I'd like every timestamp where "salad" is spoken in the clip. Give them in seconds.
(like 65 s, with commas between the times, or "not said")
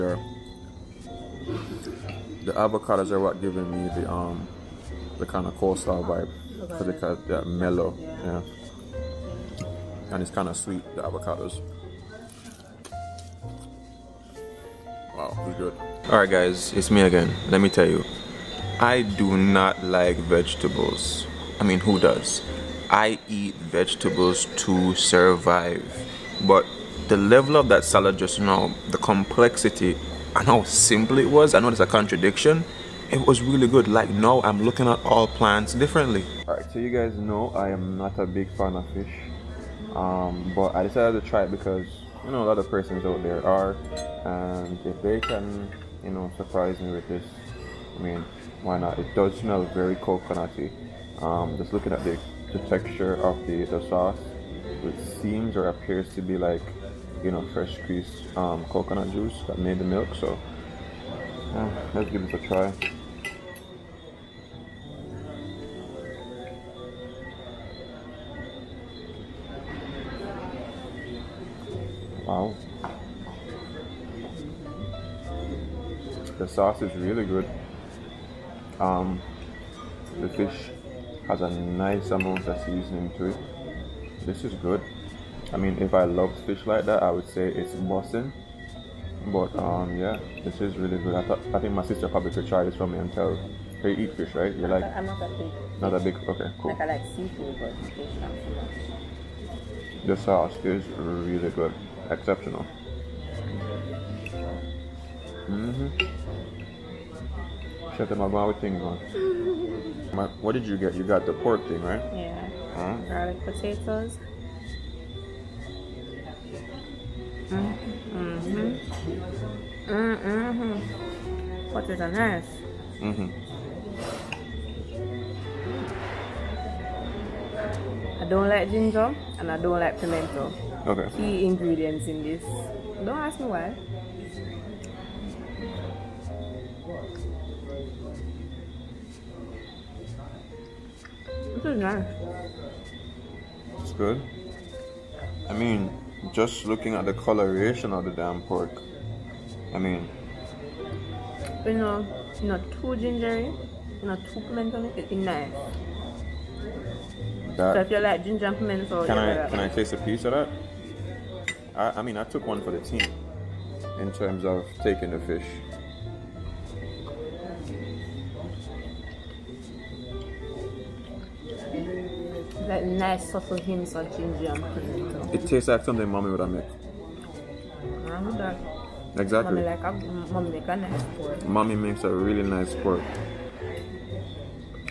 27 s.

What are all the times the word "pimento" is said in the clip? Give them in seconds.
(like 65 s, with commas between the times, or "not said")
129 s, 154 s, 158 s, 174 s.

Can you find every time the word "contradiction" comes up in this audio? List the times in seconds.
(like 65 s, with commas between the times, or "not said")
31 s.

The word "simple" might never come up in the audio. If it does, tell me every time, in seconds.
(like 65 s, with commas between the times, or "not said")
30 s.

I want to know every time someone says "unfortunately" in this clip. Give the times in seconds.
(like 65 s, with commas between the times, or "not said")
not said.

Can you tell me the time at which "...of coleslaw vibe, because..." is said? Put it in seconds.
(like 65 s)
5 s.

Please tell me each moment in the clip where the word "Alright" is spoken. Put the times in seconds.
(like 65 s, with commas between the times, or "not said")
16 s, 36 s.